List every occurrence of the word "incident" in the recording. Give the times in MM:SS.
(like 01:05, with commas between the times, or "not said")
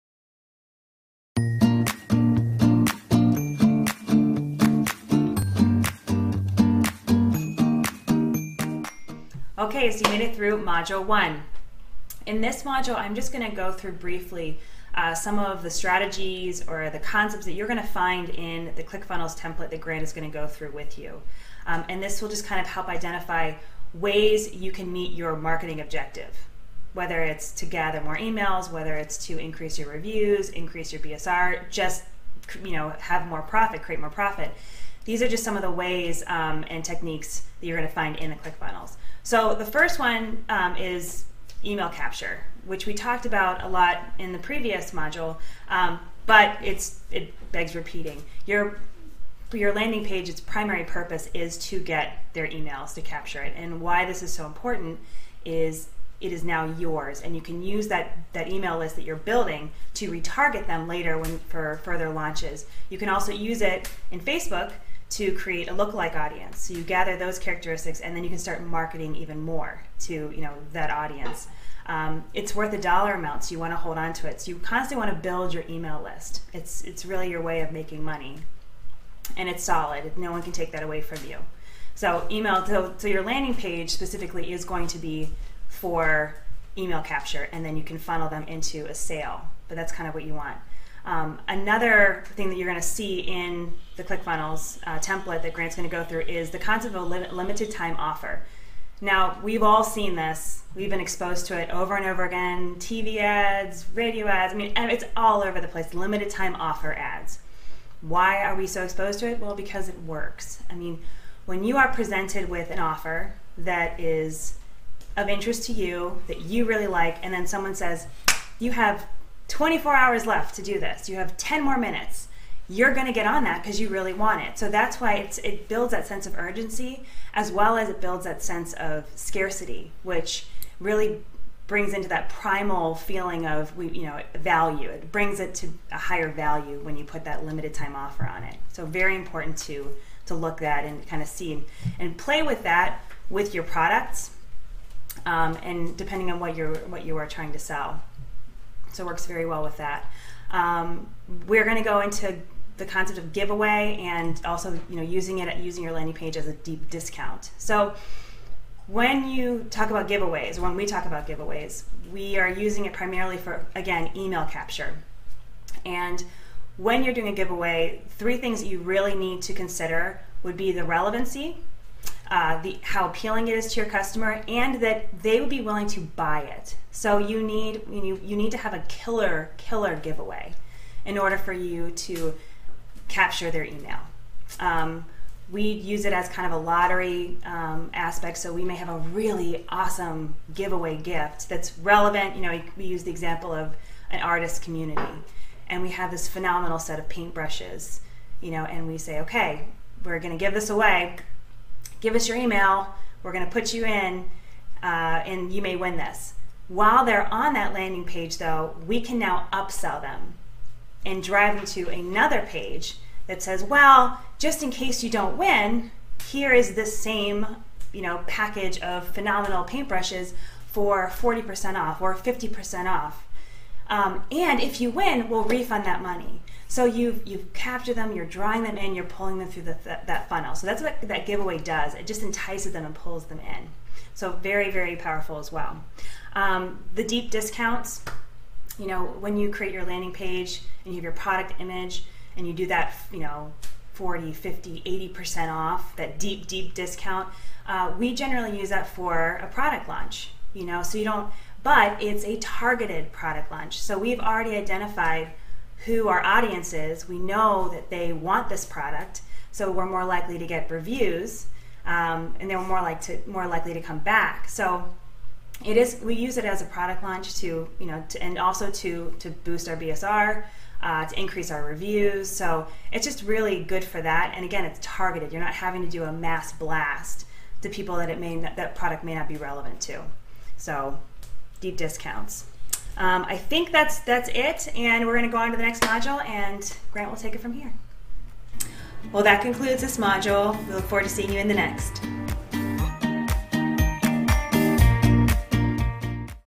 not said.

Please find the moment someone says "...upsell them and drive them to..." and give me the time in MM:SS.
03:29.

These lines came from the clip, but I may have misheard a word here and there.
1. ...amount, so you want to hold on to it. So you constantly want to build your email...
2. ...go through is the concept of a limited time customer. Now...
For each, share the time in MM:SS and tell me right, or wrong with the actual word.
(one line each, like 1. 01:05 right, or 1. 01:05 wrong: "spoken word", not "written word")
1. 01:13 right
2. 01:35 wrong: "offer", not "customer".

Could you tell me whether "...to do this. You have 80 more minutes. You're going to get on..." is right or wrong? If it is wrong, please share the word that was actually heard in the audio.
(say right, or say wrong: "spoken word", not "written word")
wrong: "10", not "80".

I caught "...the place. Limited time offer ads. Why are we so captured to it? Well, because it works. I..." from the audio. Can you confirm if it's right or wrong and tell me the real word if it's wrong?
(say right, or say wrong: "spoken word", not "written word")
wrong: "exposed", not "captured".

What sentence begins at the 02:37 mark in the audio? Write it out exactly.
So when you talk about giveaways, when we talk about giveaways, we are using it primarily for again email capture.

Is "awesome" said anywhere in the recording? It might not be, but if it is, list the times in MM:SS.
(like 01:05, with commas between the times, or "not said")
03:09.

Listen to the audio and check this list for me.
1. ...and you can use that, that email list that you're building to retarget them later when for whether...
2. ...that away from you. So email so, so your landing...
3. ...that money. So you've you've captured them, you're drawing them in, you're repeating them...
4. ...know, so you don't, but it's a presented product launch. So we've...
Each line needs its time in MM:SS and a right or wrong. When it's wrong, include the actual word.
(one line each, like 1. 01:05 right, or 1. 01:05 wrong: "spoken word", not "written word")
1. 00:57 wrong: "further", not "whether"
2. 01:20 right
3. 03:45 wrong: "pulling", not "repeating"
4. 04:10 wrong: "targeted", not "presented".